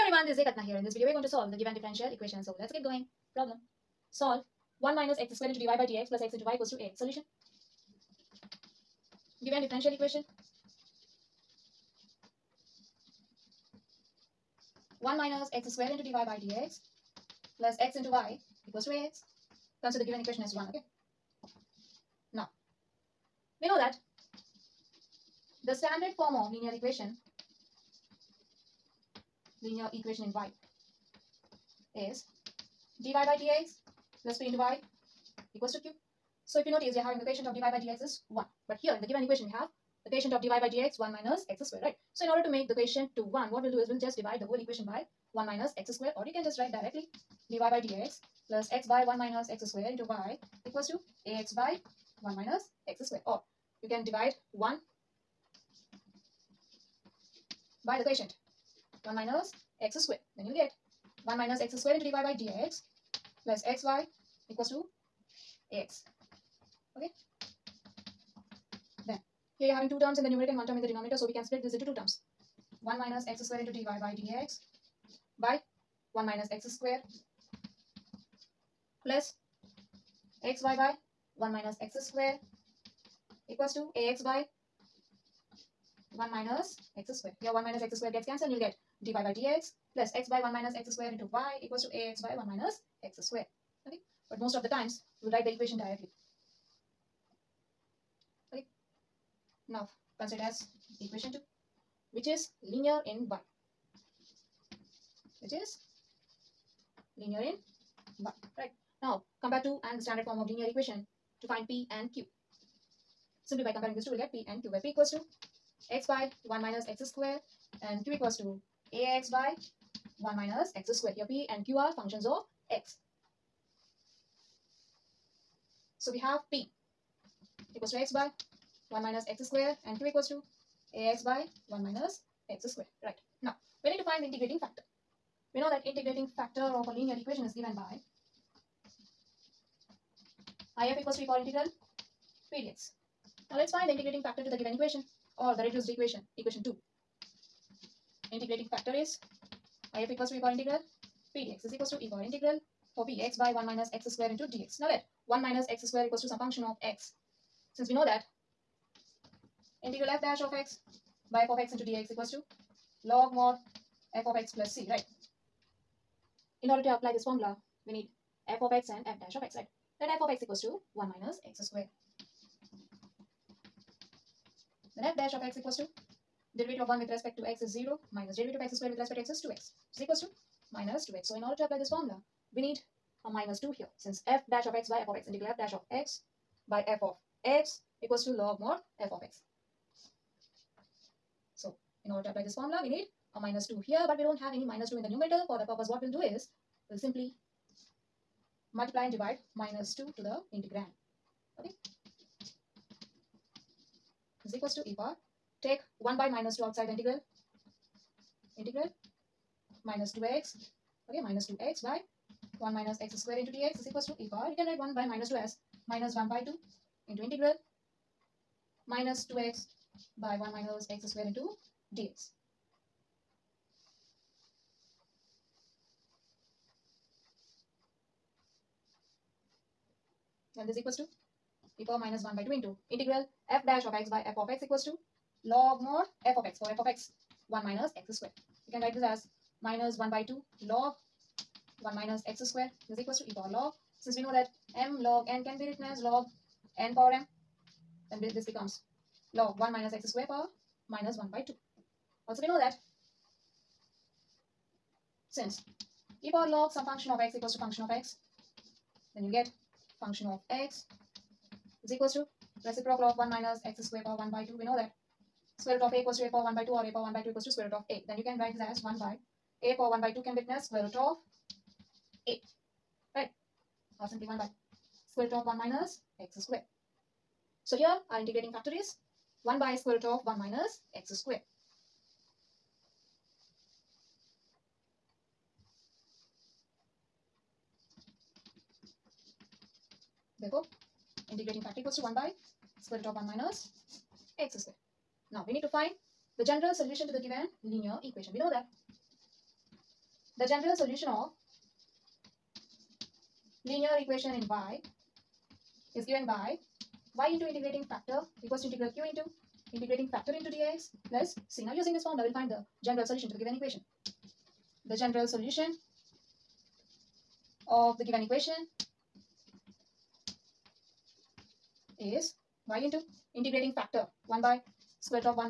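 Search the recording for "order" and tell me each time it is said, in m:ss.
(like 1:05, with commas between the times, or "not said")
0:42, 2:46, 3:01, 3:12.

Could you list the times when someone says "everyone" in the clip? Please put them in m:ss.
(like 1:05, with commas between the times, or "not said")
0:00.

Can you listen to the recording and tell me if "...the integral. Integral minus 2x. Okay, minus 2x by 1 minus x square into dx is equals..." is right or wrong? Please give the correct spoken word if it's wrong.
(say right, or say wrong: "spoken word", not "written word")
right.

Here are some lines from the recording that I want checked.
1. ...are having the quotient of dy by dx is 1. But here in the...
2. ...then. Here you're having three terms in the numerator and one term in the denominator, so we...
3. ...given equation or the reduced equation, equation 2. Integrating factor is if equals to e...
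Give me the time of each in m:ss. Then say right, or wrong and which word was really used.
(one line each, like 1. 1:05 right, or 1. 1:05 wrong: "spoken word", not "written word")
1. 0:36 right
2. 1:09 wrong: "two", not "three"
3. 2:24 right.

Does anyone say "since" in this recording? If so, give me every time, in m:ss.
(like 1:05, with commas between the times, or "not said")
2:37, 3:03, 4:04, 4:15.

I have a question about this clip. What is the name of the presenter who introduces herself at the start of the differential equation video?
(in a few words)
Kalpana.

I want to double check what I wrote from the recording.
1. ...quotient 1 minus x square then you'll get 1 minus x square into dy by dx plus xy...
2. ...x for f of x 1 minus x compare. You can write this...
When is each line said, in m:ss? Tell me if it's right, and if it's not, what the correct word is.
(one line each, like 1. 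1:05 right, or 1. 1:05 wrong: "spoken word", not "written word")
1. 0:58 right
2. 3:56 wrong: "square", not "compare".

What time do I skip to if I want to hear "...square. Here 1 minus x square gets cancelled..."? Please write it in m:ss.
1:27.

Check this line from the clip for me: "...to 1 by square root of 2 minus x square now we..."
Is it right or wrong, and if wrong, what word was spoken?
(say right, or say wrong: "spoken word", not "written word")
wrong: "1", not "2".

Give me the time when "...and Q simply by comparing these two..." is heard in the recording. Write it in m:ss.
1:51.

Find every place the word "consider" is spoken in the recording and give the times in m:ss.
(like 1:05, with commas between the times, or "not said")
0:19, 1:40.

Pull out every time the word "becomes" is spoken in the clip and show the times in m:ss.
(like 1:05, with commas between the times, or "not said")
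4:08.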